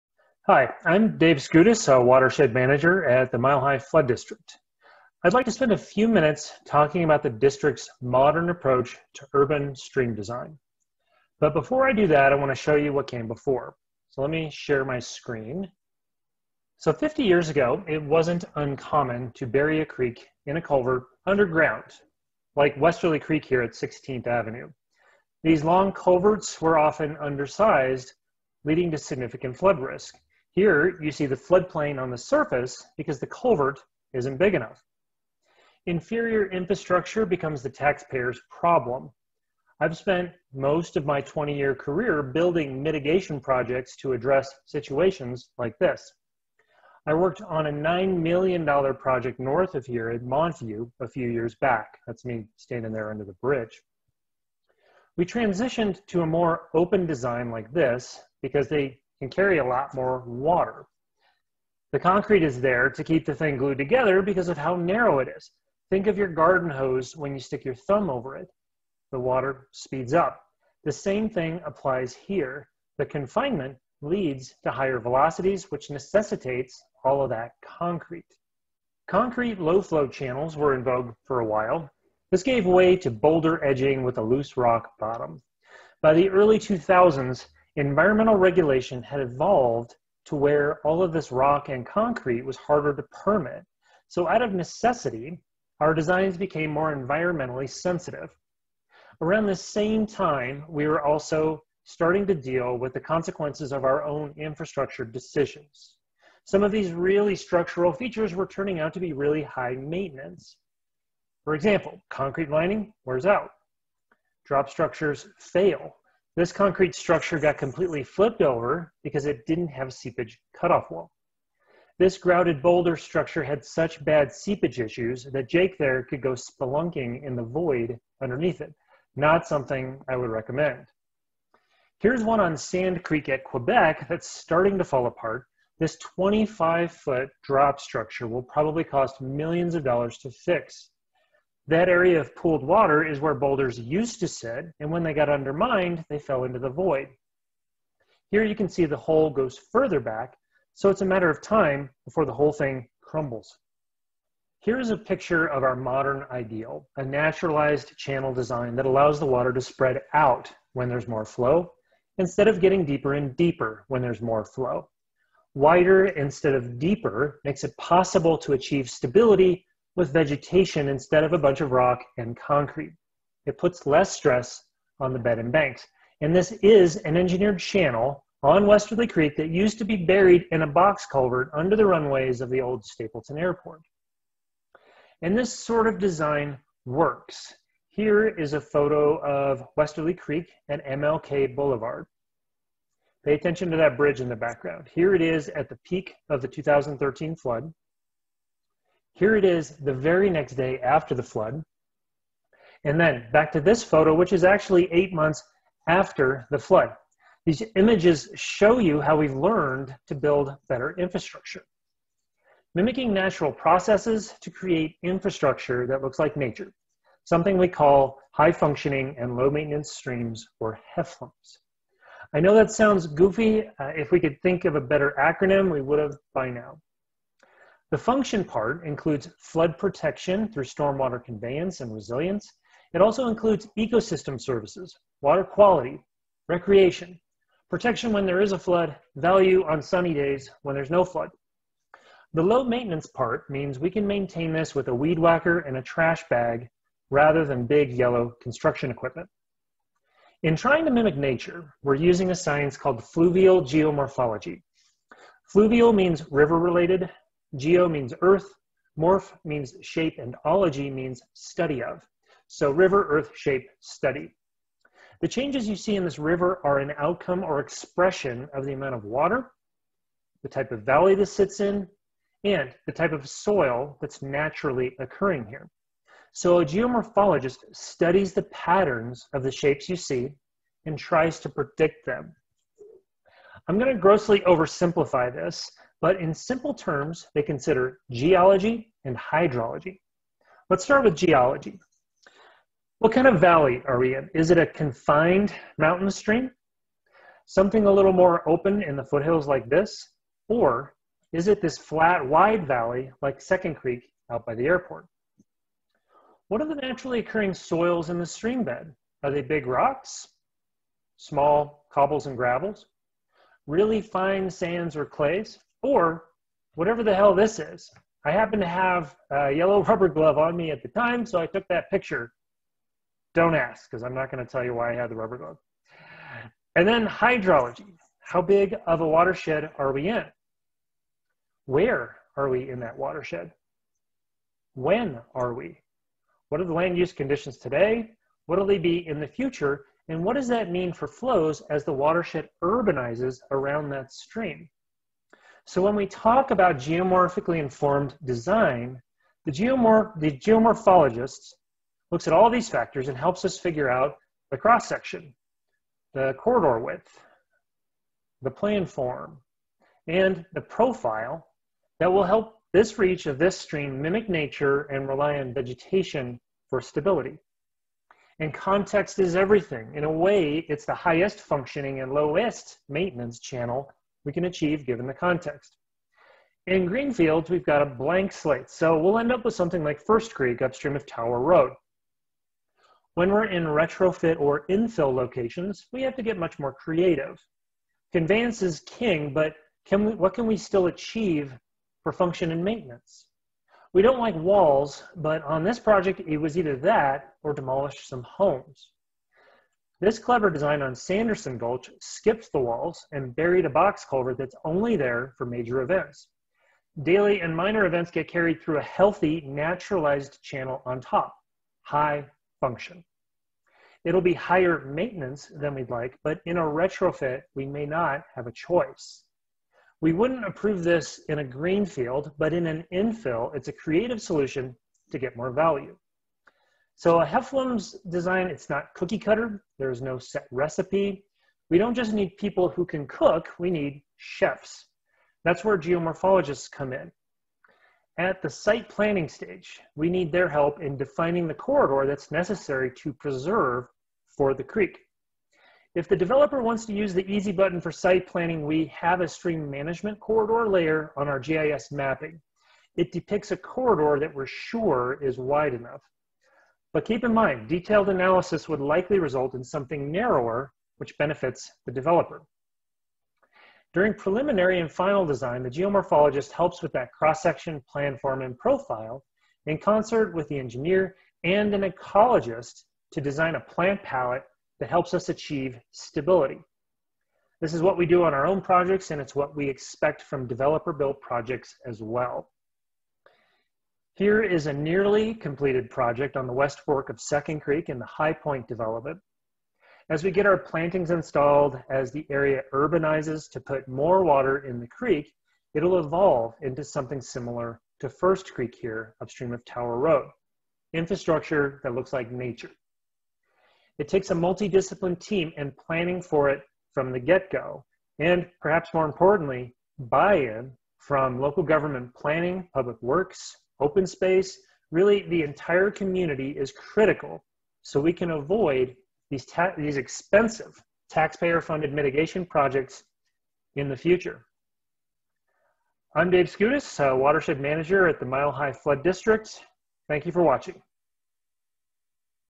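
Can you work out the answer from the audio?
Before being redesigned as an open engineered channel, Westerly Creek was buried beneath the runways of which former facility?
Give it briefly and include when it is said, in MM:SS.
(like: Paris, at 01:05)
Stapleton Airport, at 03:02.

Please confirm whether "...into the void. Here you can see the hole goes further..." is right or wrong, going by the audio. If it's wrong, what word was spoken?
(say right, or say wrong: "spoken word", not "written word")
right.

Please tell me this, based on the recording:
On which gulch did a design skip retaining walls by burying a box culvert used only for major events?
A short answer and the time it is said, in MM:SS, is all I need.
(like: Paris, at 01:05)
Sanderson Gulch, at 06:40.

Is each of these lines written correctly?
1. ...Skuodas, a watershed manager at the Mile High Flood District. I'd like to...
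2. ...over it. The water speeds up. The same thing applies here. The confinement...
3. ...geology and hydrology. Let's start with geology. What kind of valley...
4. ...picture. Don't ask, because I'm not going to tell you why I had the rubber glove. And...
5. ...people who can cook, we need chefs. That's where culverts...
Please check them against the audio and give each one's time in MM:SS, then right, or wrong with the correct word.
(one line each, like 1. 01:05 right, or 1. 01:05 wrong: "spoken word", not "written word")
1. 00:01 right
2. 01:08 right
3. 04:48 right
4. 05:21 right
5. 07:12 wrong: "geomorphologists", not "culverts".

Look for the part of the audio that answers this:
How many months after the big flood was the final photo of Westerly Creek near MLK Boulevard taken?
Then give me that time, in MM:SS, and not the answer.
03:24.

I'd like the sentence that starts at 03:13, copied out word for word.
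Pay attention to that bridge in the background.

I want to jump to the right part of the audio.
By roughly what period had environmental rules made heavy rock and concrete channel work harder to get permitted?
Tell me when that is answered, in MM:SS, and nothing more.
01:26.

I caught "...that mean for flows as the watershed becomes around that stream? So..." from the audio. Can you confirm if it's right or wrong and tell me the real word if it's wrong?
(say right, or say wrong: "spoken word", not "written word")
wrong: "urbanizes", not "becomes".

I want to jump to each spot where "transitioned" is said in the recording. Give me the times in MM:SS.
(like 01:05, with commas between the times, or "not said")
00:55.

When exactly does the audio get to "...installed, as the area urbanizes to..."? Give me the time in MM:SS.
08:11.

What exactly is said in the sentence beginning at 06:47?
Daily and minor events get carried through a healthy, naturalized channel on top, high function.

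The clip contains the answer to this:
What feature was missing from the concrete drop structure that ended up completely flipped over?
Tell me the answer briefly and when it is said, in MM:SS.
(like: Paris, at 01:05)
seepage cutoff wall, at 01:59.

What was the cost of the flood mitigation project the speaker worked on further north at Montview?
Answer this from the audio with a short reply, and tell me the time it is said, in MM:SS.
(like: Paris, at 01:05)
$9 million, at 00:47.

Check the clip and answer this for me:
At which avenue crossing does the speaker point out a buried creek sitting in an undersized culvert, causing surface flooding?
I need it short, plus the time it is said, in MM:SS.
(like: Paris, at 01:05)
16th Avenue, at 00:23.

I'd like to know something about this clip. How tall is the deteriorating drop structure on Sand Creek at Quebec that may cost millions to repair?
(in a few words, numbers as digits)
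25 feet.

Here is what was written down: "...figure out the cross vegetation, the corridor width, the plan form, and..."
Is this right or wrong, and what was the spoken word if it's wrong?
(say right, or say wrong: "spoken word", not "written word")
wrong: "section", not "vegetation".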